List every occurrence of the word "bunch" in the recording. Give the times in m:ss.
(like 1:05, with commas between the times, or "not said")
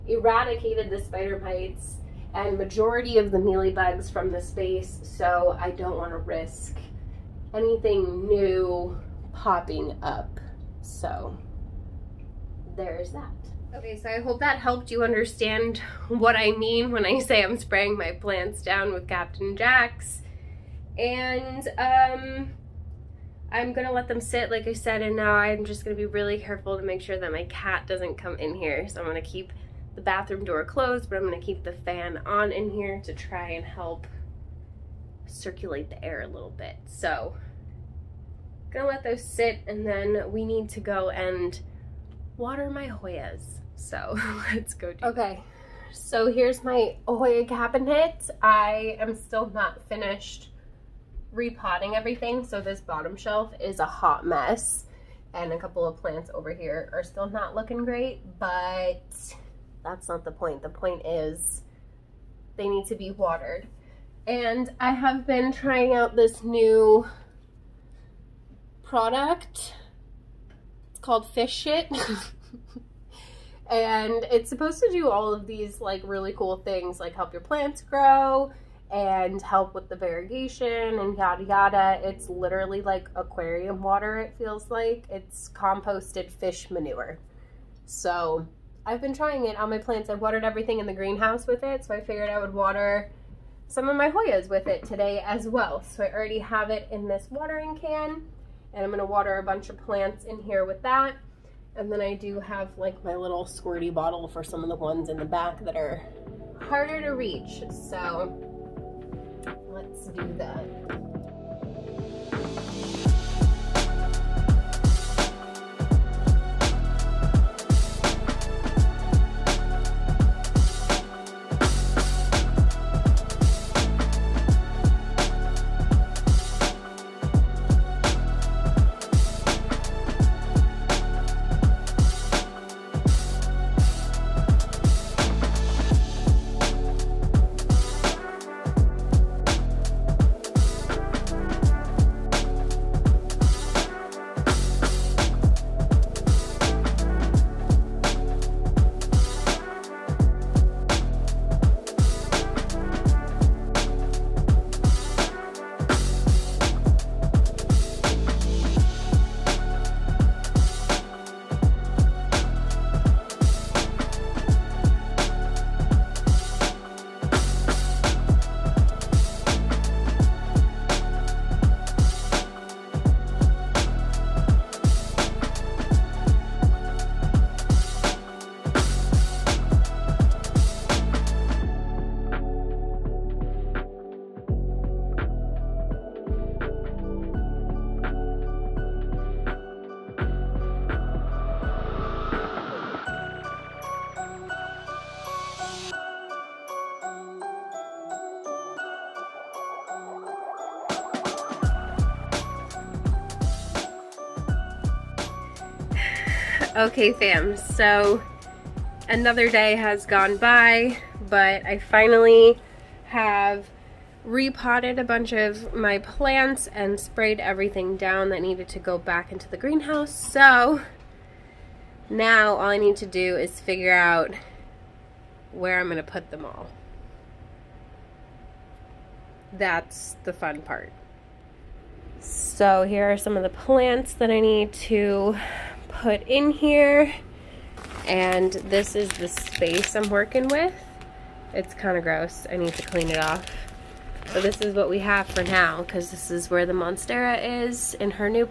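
1:39, 3:35.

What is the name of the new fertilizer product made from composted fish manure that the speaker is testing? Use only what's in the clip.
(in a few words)
Fish Shit.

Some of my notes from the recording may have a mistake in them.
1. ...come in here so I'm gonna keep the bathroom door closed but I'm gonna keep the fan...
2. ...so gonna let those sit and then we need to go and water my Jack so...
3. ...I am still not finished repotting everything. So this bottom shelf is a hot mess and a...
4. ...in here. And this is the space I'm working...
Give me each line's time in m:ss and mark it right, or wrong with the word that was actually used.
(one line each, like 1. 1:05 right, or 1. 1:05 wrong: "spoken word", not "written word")
1. 0:28 right
2. 0:36 wrong: "Hoyas", not "Jack"
3. 0:48 right
4. 3:56 right.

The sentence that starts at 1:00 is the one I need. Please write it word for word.
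The point is they need to be watered.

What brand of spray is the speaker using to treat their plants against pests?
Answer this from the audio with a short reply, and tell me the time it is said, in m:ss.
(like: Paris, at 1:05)
Captain Jack's, at 0:19.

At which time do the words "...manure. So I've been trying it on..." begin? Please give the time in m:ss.
1:26.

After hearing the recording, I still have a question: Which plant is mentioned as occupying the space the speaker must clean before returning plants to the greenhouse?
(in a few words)
Monstera.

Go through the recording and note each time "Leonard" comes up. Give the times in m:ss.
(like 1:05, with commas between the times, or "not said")
not said.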